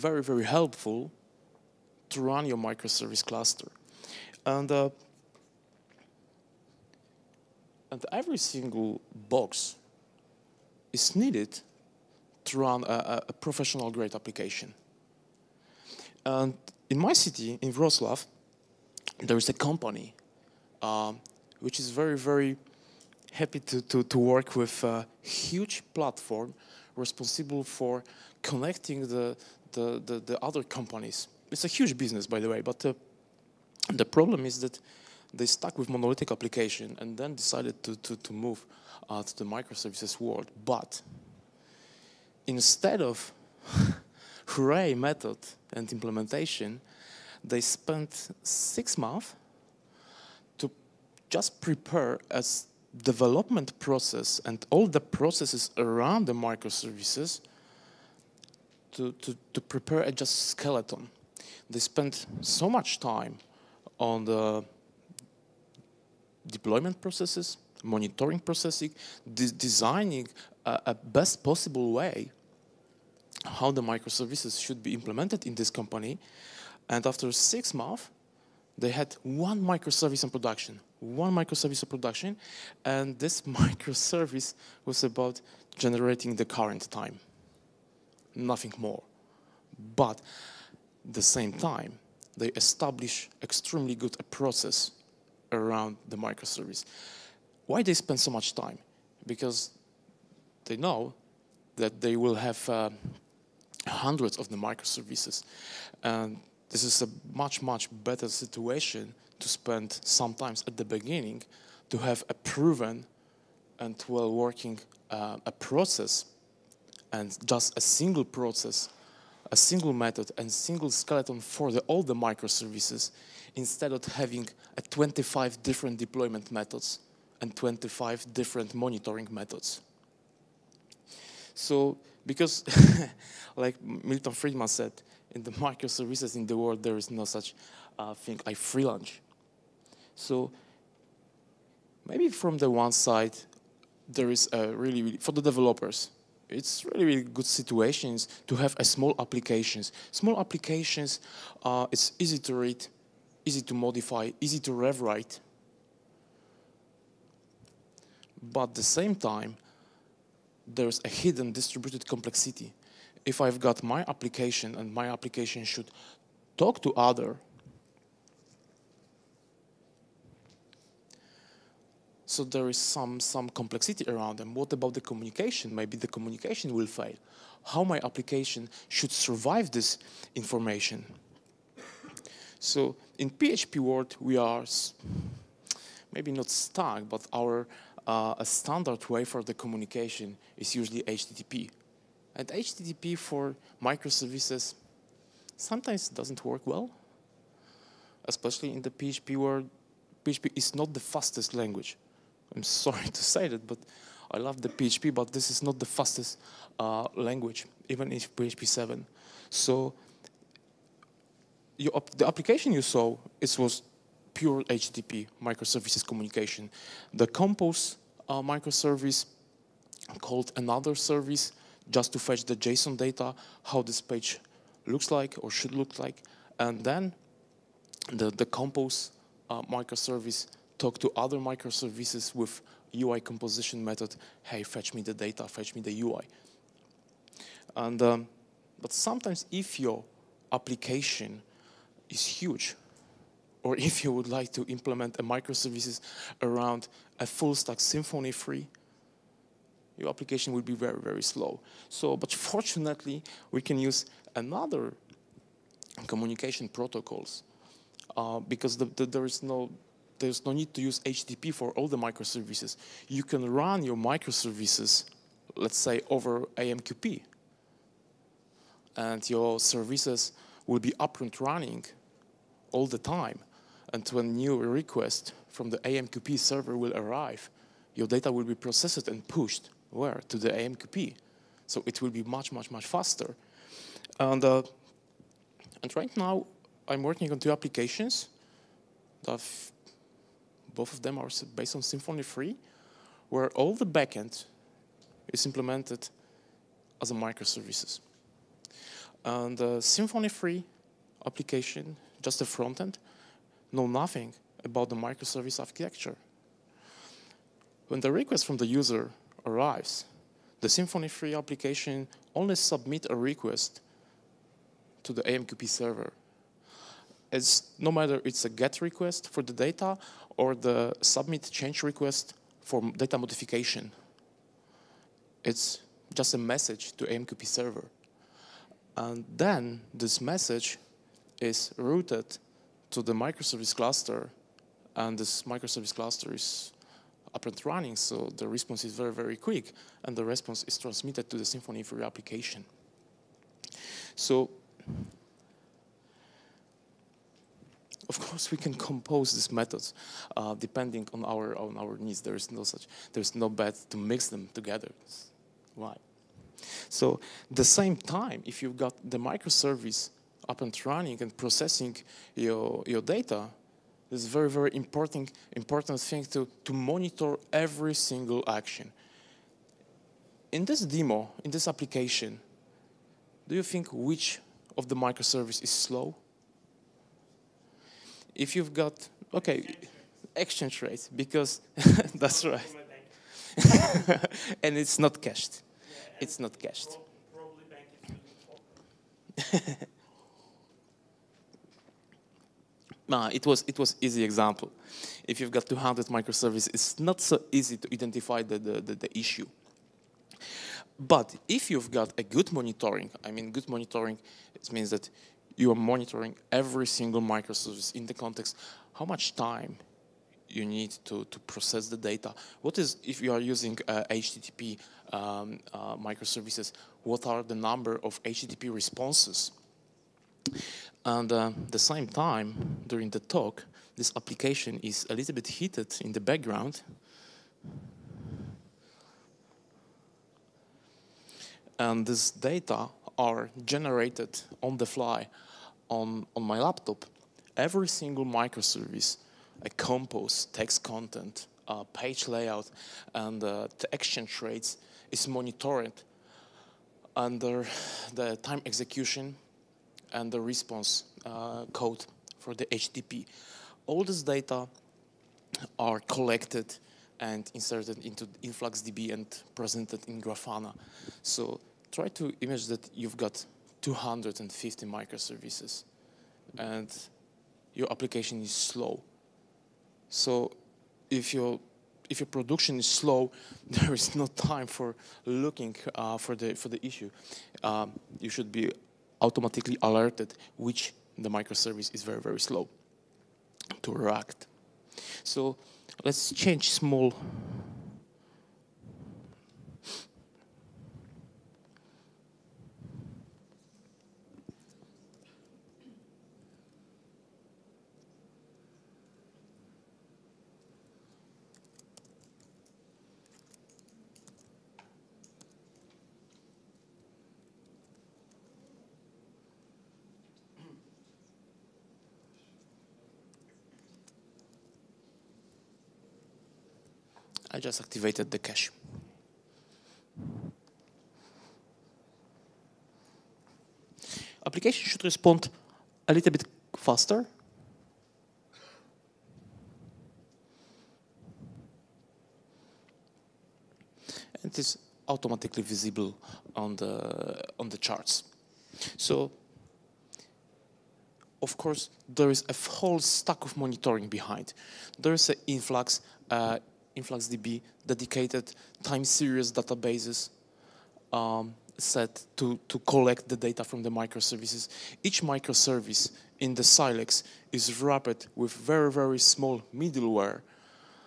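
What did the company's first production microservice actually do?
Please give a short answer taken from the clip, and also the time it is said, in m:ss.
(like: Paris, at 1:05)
Generating the current time, at 1:25.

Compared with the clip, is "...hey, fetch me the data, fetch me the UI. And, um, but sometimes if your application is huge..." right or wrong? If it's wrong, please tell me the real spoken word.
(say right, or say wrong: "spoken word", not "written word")
right.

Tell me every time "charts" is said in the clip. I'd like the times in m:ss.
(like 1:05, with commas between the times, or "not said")
8:57.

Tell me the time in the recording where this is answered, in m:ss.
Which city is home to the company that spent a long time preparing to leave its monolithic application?
0:17.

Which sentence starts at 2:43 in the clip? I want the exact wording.
If I've got my application and my application should talk to other, so there is some, some complexity around them.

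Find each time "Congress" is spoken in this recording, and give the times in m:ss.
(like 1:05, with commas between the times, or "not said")
not said.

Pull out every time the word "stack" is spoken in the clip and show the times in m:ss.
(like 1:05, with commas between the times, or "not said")
4:07, 9:02.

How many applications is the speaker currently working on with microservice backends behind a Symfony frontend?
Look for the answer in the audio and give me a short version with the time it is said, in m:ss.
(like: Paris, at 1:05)
2, at 4:47.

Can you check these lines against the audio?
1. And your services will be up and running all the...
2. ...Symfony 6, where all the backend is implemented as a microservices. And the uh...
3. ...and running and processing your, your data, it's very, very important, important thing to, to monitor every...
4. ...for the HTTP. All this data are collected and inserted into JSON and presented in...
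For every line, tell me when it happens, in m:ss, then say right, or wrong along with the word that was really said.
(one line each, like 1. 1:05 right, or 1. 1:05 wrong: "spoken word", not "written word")
1. 4:28 right
2. 4:51 wrong: "3", not "6"
3. 6:00 right
4. 7:32 wrong: "InfluxDB", not "JSON".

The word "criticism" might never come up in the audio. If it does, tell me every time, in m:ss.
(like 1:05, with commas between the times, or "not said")
not said.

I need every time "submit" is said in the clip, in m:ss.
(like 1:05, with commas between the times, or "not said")
5:12, 5:21.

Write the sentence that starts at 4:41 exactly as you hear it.
So it will be much, much, much faster.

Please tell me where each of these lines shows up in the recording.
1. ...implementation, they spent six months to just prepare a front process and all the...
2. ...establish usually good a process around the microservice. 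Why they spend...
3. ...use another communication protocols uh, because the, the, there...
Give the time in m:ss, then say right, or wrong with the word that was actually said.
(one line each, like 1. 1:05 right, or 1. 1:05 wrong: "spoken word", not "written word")
1. 0:45 wrong: "development", not "front"
2. 1:32 wrong: "extremely", not "usually"
3. 4:13 right.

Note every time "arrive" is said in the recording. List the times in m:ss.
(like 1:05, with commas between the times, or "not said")
4:36, 5:09.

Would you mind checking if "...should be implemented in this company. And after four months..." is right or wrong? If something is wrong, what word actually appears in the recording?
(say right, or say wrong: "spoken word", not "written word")
wrong: "six", not "four".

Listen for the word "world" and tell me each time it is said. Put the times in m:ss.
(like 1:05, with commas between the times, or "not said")
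0:40, 2:16, 3:03, 3:19.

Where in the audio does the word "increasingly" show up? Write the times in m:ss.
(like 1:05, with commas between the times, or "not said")
not said.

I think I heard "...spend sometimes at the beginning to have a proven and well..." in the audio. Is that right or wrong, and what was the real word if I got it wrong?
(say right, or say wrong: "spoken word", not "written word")
right.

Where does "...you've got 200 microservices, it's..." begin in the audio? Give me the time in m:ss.
6:35.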